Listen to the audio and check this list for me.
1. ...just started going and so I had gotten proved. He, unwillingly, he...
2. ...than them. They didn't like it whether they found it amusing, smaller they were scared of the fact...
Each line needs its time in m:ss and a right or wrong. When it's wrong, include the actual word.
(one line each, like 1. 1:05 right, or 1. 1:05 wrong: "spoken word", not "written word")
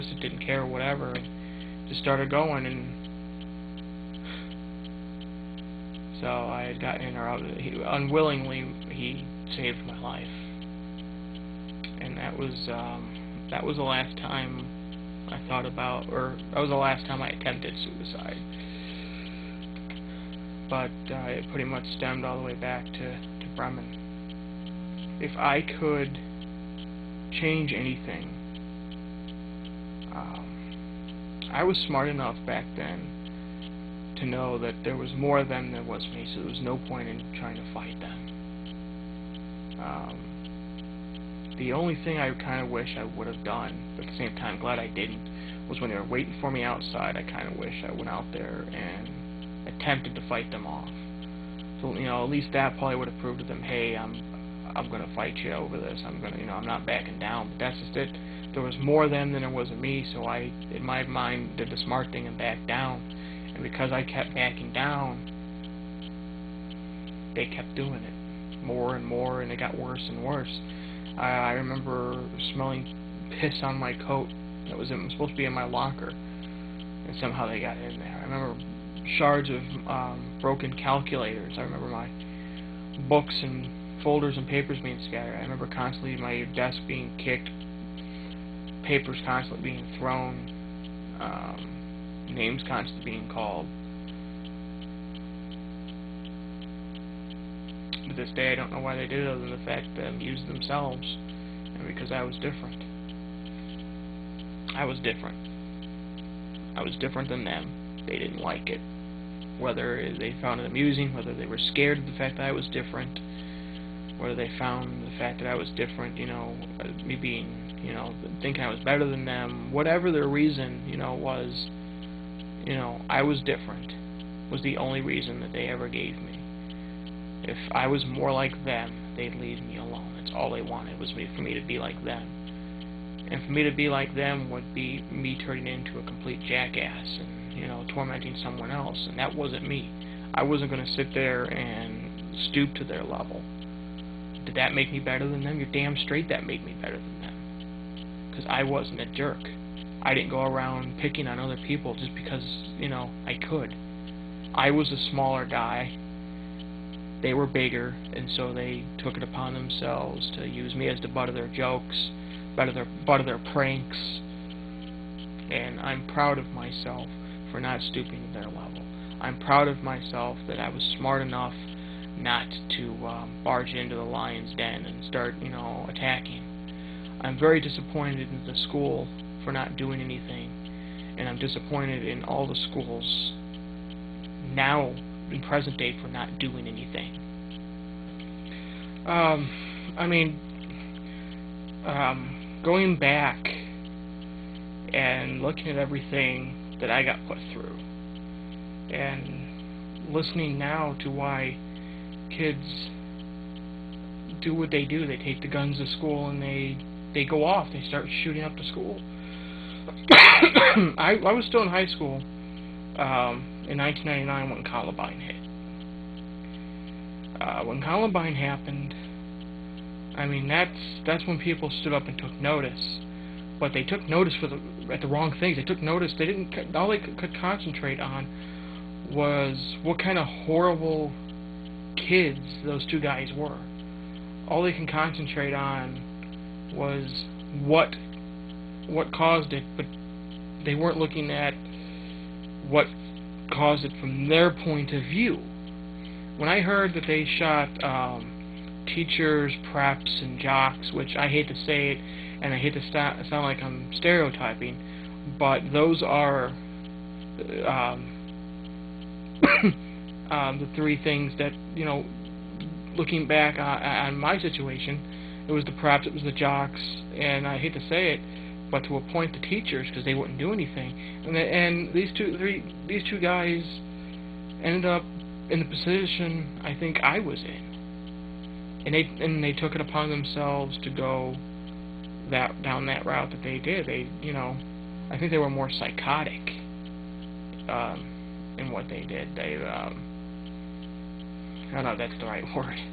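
1. 0:01 wrong: "interrupted", not "proved"
2. 1:47 wrong: "whether", not "smaller".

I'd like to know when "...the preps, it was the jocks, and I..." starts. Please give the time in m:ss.
4:25.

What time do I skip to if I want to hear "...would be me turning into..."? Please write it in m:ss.
2:14.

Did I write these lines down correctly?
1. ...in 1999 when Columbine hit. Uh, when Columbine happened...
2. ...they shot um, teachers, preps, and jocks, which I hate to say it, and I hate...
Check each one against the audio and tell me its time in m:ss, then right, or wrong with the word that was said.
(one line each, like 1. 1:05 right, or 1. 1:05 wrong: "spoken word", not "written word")
1. 3:33 right
2. 4:07 right.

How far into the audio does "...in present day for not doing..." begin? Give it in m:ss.
3:05.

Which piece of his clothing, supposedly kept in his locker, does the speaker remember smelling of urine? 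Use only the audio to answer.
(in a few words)
coat.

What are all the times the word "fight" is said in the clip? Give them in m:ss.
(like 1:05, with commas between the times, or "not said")
0:37, 0:50, 0:55.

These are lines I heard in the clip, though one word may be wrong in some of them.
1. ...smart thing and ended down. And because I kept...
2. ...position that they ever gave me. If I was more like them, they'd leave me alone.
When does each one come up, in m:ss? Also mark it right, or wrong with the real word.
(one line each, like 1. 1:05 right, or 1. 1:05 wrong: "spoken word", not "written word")
1. 1:01 wrong: "backed", not "ended"
2. 2:05 wrong: "reason", not "position".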